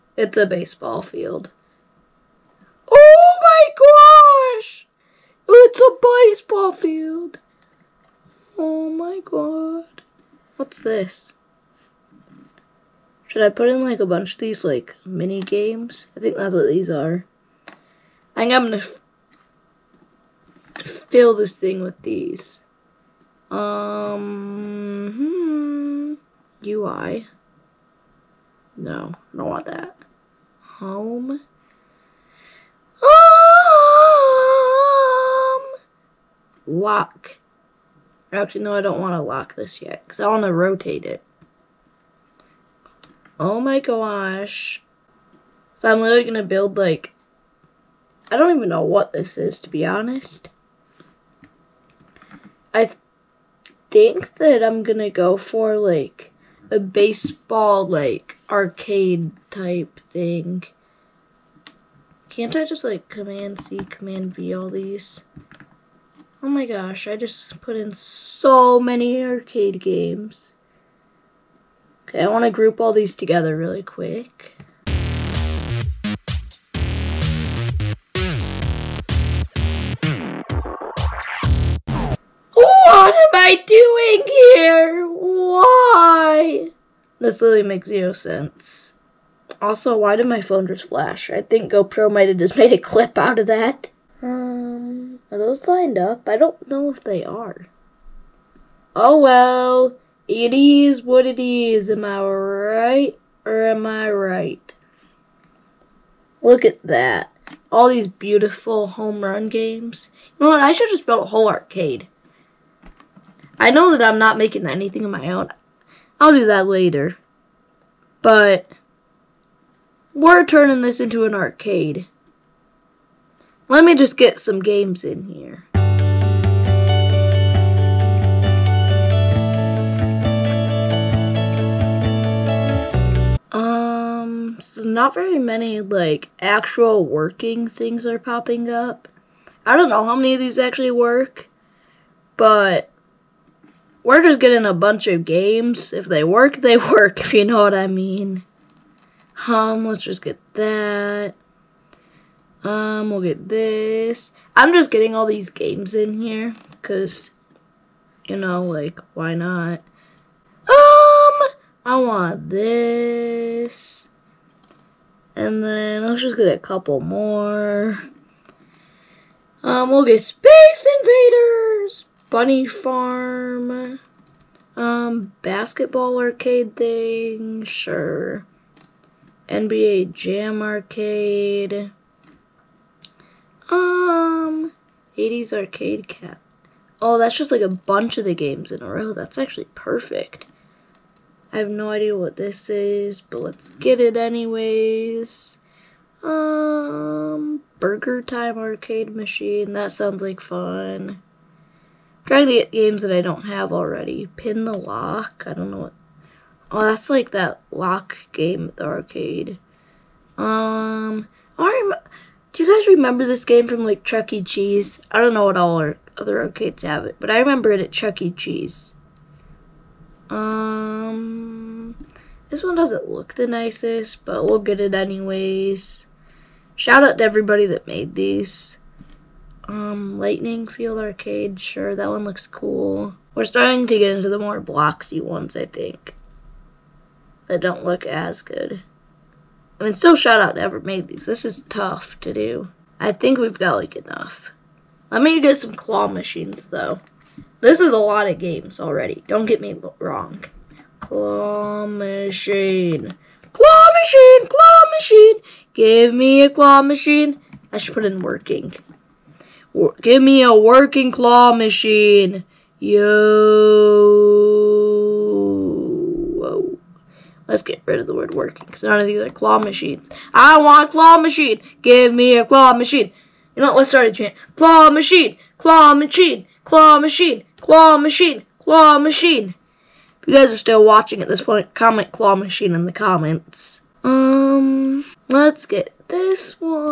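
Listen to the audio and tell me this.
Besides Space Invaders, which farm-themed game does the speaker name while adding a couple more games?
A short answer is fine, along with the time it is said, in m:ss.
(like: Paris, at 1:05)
Bunny Farm, at 2:52.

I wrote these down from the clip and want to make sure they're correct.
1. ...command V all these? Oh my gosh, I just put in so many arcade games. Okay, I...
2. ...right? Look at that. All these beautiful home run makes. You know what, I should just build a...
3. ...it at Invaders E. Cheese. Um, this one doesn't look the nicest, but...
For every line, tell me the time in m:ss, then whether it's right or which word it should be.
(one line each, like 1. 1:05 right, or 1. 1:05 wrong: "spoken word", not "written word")
1. 1:03 right
2. 1:44 wrong: "games", not "makes"
3. 3:37 wrong: "Chuck", not "Invaders".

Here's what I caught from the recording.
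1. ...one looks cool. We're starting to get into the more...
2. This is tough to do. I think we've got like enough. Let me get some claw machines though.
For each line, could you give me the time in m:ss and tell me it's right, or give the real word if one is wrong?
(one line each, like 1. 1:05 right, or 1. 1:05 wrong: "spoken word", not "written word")
1. 3:52 right
2. 4:01 right.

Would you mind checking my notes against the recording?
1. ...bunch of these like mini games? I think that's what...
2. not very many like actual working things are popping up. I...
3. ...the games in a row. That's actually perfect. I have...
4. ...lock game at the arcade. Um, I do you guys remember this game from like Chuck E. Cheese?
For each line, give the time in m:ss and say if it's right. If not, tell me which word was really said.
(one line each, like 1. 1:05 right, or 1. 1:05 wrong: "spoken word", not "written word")
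1. 0:14 right
2. 2:14 right
3. 3:08 right
4. 3:27 right.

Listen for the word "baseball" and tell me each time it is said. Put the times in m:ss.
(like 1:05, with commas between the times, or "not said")
0:00, 0:06, 0:56.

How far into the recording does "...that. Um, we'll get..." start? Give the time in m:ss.
2:30.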